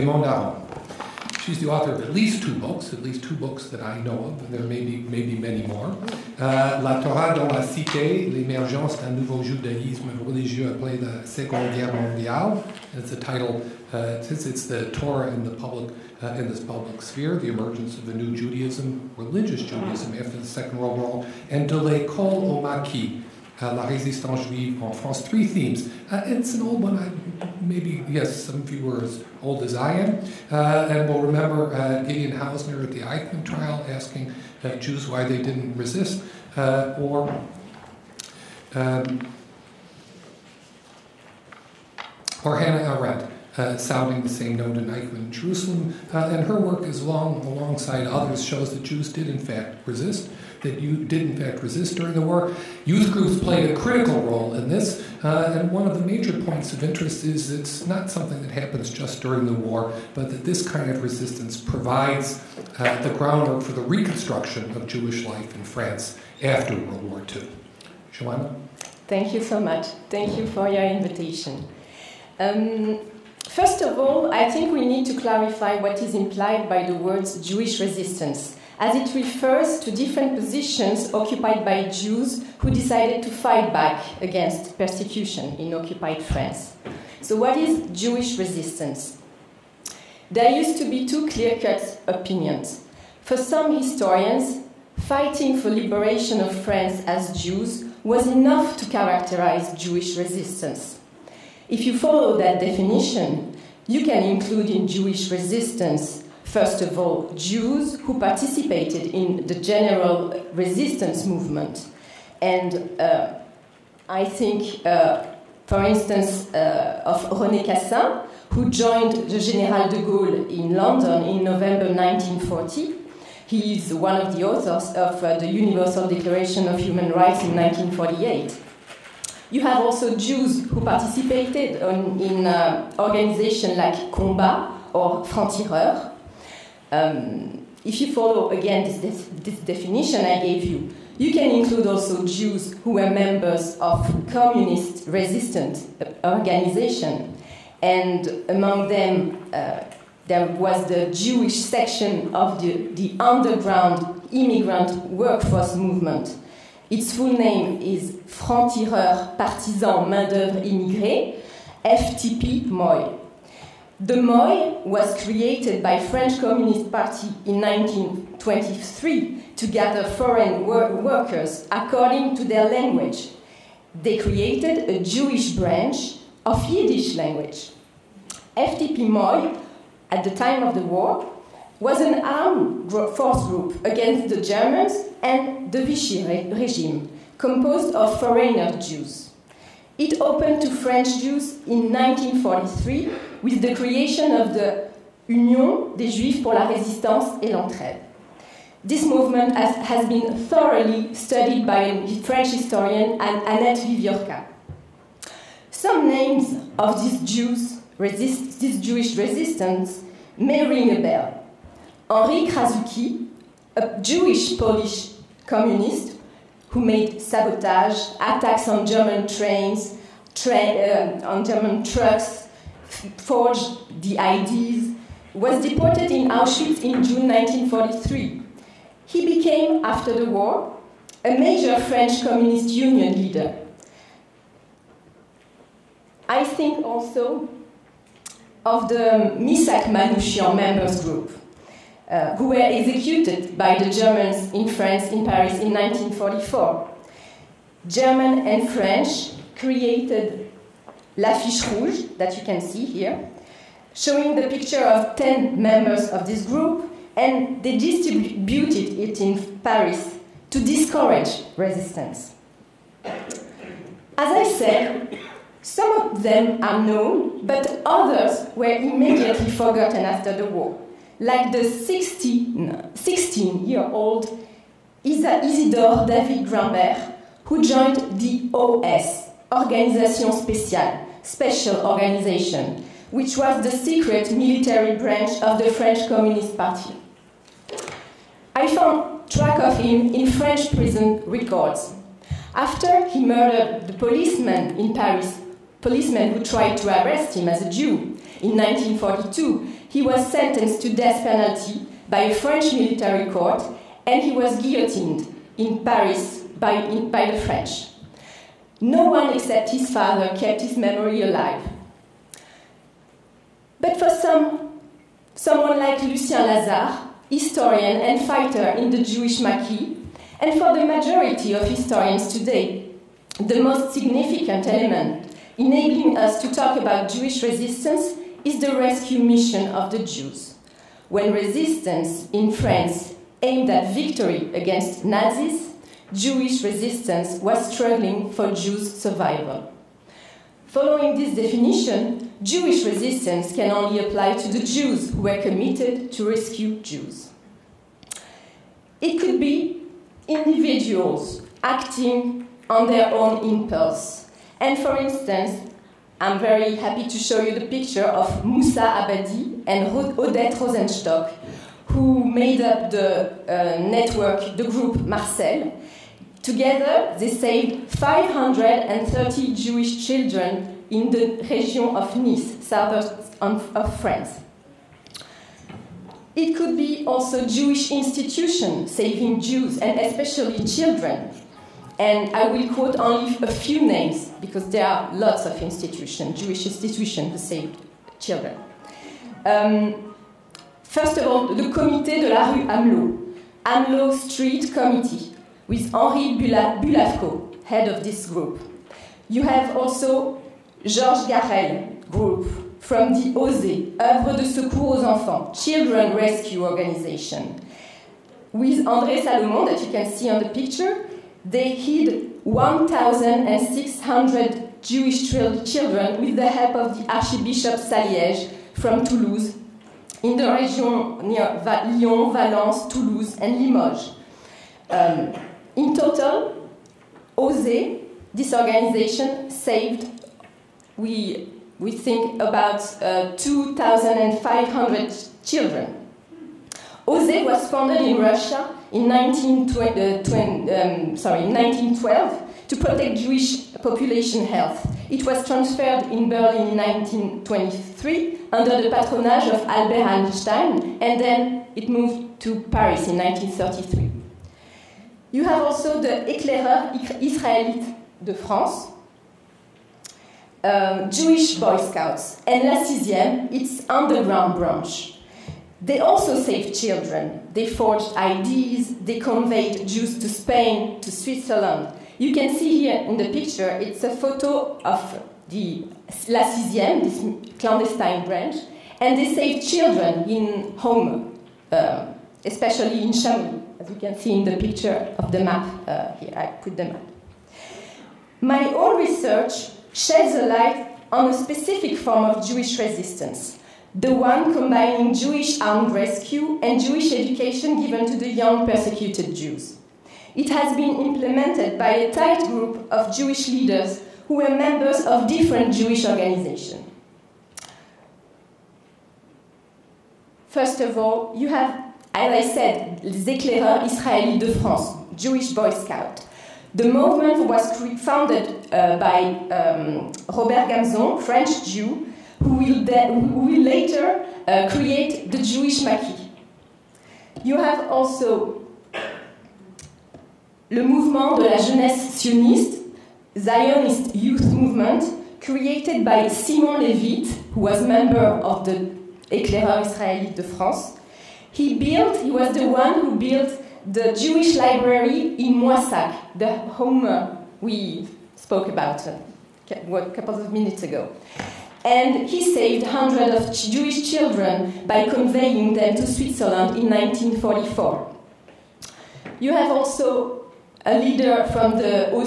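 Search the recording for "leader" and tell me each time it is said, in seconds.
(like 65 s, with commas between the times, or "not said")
233 s, 503 s, 560 s.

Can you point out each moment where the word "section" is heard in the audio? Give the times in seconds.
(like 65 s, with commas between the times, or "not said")
151 s.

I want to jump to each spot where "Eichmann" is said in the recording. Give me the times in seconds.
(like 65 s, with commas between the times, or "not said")
33 s, 44 s.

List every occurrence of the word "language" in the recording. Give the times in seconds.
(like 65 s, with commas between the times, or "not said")
172 s, 177 s.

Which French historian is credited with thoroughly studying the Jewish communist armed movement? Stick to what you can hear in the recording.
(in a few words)
Annette Wieviorka.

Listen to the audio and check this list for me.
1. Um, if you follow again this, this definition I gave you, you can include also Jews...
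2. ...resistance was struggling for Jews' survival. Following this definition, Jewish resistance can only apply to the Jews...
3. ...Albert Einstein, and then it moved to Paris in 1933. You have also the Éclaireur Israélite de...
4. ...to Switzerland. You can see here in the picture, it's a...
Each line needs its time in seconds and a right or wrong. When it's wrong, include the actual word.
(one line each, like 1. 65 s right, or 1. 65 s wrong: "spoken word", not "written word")
1. 136 s right
2. 336 s right
3. 449 s right
4. 471 s right.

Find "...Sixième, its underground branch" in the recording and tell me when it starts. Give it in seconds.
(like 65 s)
462 s.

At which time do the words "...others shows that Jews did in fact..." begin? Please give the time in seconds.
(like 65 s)
48 s.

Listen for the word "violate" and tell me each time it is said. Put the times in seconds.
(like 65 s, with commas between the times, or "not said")
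not said.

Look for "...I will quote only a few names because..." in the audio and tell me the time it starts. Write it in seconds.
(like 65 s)
382 s.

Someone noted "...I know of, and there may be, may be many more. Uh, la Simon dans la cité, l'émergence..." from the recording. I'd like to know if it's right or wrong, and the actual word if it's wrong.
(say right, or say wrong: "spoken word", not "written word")
wrong: "Torah", not "Simon".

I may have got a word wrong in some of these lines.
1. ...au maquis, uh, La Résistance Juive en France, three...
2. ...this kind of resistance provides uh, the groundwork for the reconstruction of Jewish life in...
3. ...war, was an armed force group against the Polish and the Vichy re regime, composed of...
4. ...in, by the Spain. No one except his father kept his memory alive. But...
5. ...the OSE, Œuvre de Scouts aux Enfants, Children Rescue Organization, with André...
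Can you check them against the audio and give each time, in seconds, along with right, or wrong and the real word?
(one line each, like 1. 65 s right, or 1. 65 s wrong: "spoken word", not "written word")
1. 22 s right
2. 60 s right
3. 180 s wrong: "Germans", not "Polish"
4. 306 s wrong: "French", not "Spain"
5. 403 s wrong: "Secours", not "Scouts".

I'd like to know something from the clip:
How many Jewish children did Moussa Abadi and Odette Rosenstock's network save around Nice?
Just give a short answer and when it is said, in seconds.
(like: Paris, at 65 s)
530, at 367 s.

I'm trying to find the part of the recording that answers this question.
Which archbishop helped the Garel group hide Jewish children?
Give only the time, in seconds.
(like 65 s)
417 s.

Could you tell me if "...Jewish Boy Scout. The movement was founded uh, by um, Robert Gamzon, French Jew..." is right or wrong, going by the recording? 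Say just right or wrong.
right.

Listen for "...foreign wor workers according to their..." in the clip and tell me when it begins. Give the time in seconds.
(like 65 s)
170 s.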